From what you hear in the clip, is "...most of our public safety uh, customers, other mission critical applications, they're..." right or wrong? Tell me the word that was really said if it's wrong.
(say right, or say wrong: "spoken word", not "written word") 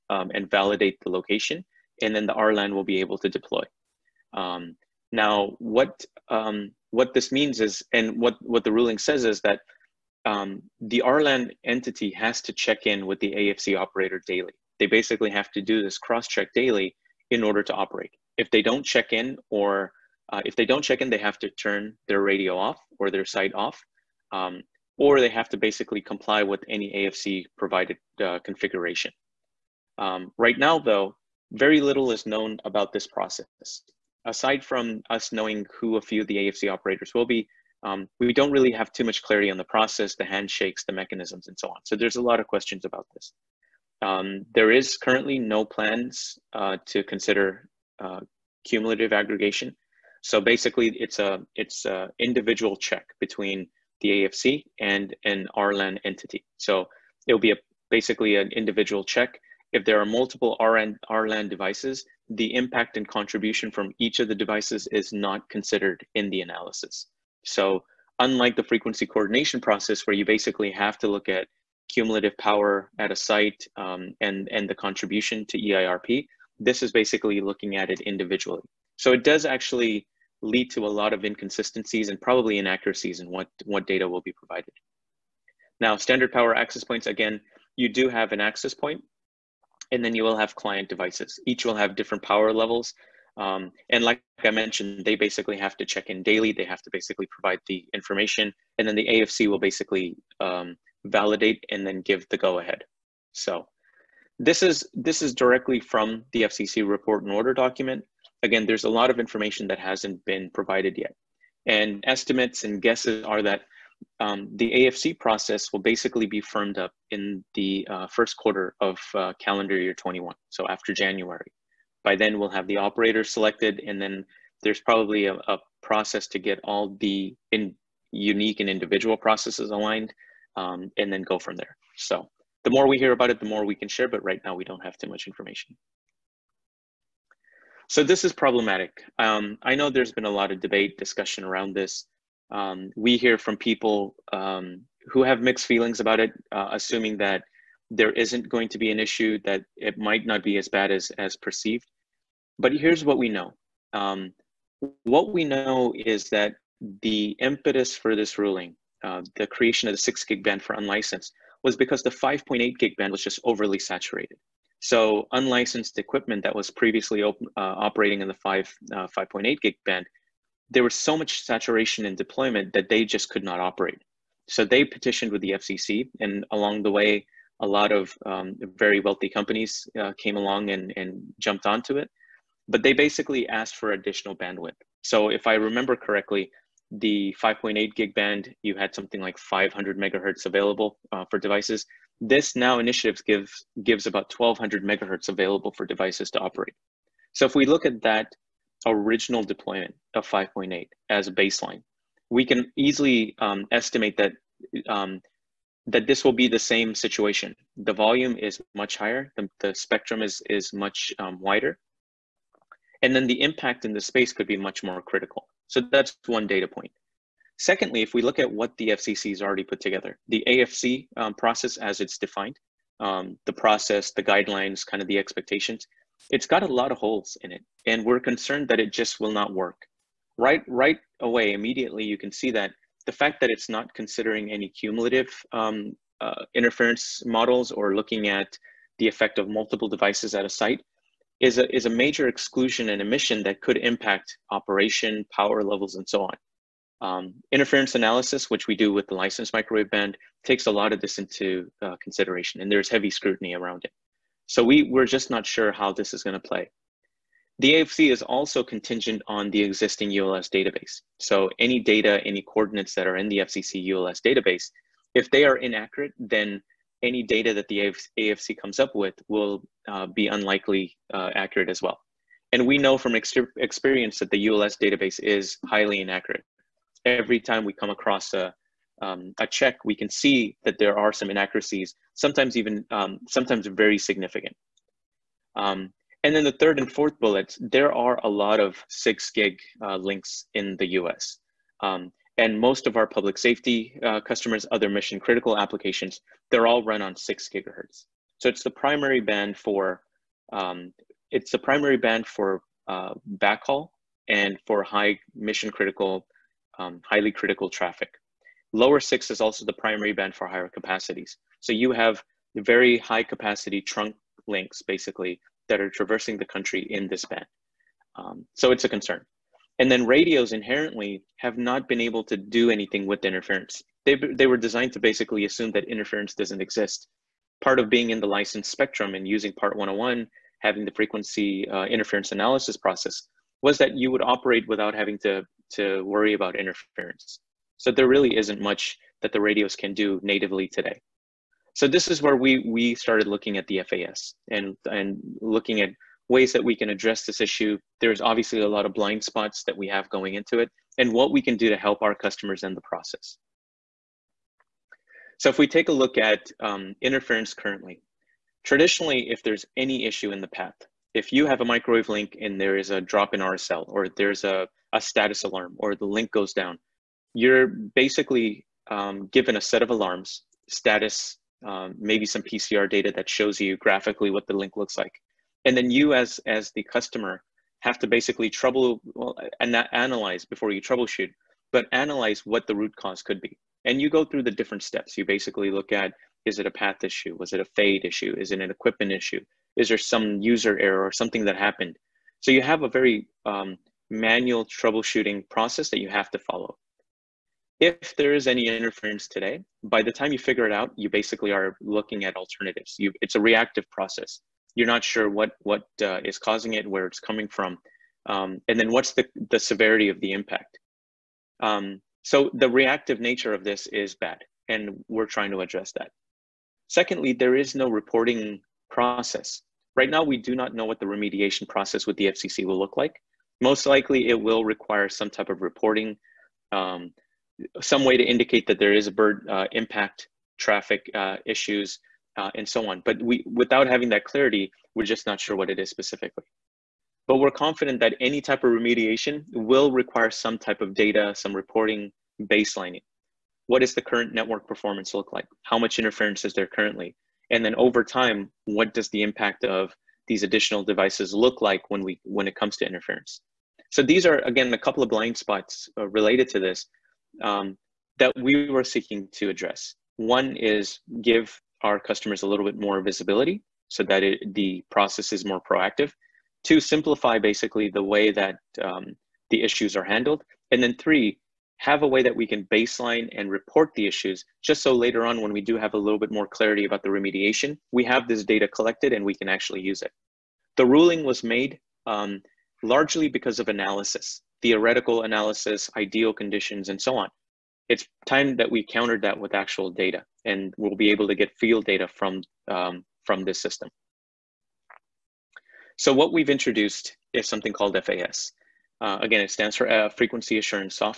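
right.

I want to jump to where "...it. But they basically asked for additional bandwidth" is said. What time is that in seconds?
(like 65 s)
181 s.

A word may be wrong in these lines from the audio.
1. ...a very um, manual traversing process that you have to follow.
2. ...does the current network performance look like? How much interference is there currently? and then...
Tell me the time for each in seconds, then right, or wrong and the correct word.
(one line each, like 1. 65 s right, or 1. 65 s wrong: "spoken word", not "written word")
1. 392 s wrong: "troubleshooting", not "traversing"
2. 443 s right.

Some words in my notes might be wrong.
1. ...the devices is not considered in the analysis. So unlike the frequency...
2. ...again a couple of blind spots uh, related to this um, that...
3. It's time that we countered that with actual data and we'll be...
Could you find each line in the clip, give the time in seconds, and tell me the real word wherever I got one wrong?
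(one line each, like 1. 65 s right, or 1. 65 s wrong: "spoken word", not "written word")
1. 64 s right
2. 454 s right
3. 487 s right.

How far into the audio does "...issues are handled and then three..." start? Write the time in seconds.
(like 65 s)
469 s.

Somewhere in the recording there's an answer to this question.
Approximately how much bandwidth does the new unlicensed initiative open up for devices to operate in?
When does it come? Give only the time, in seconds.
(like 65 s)
194 s.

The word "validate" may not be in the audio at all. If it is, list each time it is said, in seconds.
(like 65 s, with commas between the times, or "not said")
0 s, 101 s.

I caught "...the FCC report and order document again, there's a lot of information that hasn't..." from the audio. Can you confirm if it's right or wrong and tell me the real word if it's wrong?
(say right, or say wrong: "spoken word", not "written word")
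right.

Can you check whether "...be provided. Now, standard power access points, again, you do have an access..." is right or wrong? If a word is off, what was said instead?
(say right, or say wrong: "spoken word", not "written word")
right.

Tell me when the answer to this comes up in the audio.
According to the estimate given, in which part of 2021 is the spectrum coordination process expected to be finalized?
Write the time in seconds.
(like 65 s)
118 s.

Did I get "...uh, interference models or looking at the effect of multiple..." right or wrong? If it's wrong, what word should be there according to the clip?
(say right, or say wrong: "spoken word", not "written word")
right.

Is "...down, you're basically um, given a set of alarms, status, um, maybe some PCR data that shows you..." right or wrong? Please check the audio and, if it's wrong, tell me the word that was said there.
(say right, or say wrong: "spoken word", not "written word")
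right.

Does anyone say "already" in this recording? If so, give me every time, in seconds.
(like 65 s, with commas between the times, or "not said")
219 s.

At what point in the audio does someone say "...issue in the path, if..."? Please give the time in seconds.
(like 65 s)
360 s.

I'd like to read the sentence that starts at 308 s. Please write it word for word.
Lower six is also the primary band for higher capacities.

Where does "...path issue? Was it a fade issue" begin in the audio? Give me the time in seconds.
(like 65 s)
386 s.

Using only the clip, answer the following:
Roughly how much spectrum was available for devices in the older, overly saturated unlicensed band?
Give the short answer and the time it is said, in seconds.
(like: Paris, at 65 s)
500 megahertz, at 189 s.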